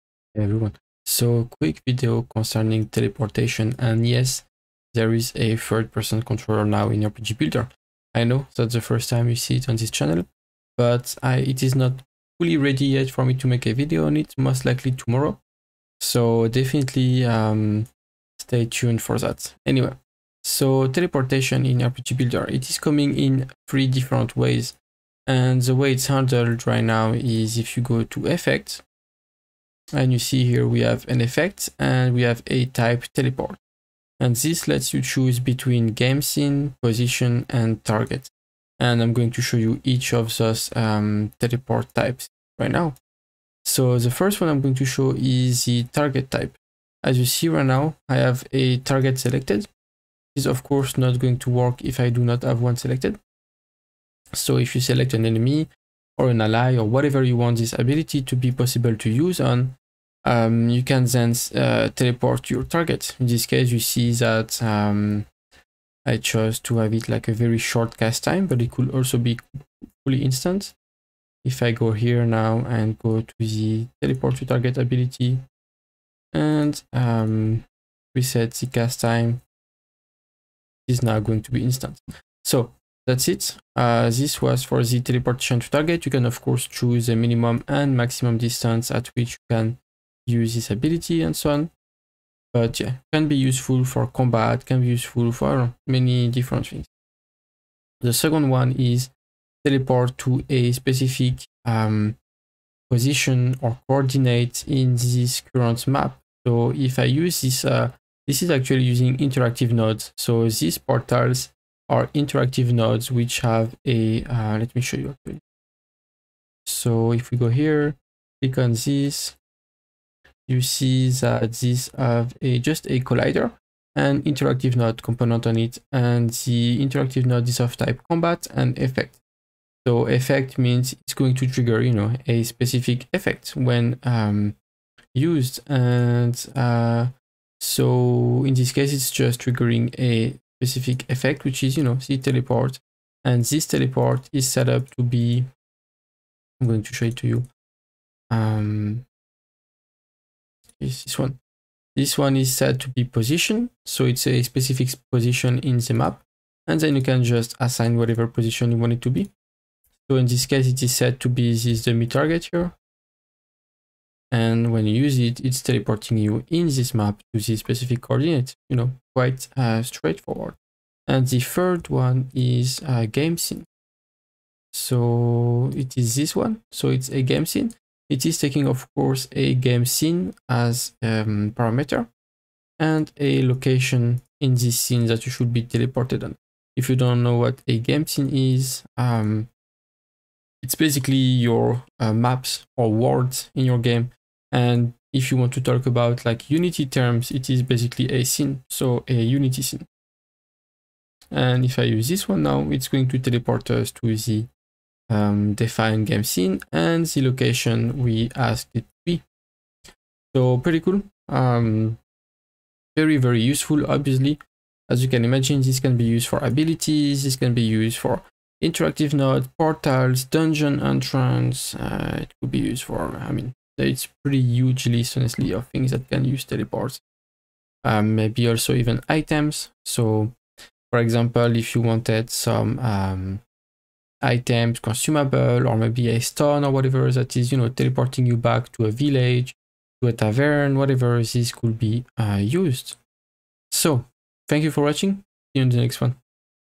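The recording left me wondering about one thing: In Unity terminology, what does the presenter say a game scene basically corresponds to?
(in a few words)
A Unity scene.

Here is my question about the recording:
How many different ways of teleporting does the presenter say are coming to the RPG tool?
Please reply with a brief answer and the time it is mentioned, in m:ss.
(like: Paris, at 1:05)
3, at 0:23.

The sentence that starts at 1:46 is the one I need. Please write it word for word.
So if I use this, uh, this is actually using interactive nodes.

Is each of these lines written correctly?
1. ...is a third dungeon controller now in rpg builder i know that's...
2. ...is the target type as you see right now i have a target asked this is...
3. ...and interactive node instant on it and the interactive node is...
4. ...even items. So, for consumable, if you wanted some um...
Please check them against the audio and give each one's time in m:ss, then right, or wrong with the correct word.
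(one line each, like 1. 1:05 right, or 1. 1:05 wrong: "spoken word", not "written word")
1. 0:05 wrong: "person", not "dungeon"
2. 0:45 wrong: "selected", not "asked"
3. 2:03 wrong: "component", not "instant"
4. 3:48 wrong: "example", not "consumable".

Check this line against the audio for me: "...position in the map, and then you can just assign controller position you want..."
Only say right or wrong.
wrong.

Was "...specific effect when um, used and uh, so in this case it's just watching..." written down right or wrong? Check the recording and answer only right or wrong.
wrong.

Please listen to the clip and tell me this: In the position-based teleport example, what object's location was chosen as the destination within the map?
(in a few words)
dummy target.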